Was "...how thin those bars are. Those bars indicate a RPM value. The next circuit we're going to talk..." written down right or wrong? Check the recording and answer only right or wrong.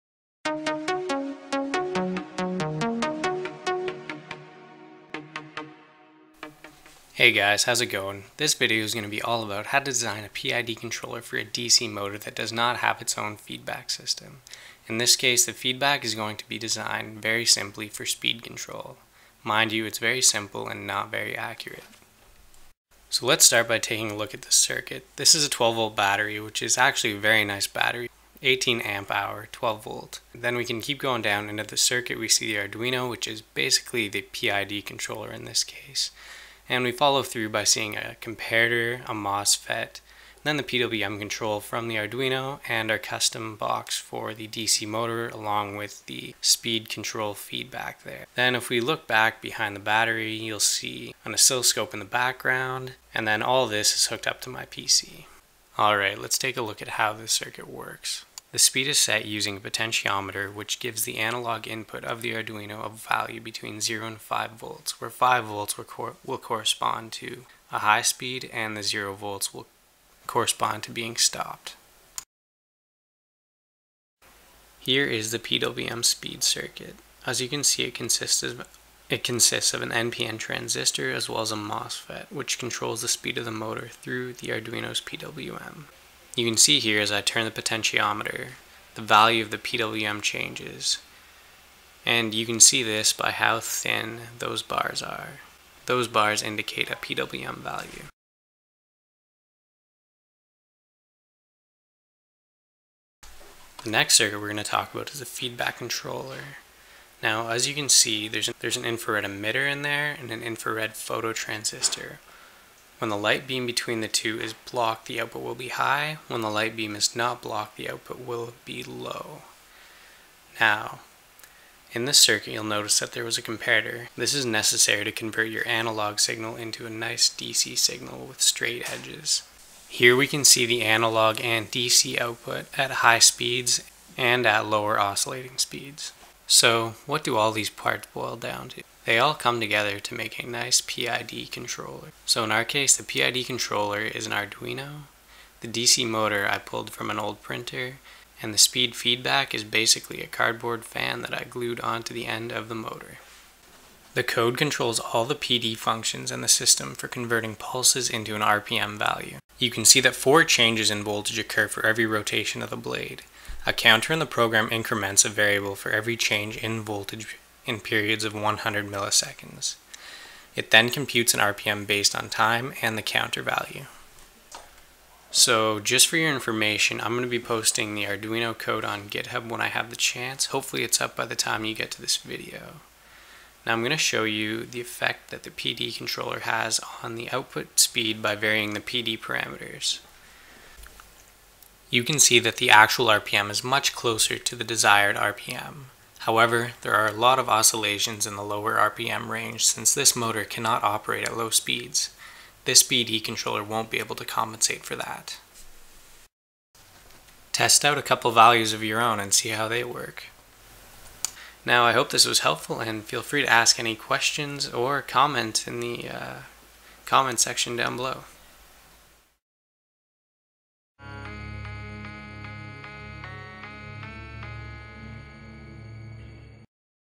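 wrong.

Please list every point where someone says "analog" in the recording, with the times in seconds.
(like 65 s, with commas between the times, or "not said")
61 s, 125 s, 130 s.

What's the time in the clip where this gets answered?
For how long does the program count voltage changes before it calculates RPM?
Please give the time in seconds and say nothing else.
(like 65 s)
168 s.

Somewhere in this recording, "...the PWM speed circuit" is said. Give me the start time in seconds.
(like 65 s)
75 s.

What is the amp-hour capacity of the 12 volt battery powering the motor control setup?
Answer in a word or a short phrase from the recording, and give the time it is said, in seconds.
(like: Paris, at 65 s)
18 amp hour, at 28 s.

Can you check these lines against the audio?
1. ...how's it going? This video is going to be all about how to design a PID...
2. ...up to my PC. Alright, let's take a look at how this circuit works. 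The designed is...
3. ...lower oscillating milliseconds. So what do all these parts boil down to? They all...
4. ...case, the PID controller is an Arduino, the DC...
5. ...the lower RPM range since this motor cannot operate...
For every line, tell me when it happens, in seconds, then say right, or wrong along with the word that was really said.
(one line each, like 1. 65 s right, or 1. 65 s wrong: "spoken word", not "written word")
1. 7 s right
2. 54 s wrong: "speed", not "designed"
3. 134 s wrong: "speeds", not "milliseconds"
4. 142 s right
5. 198 s right.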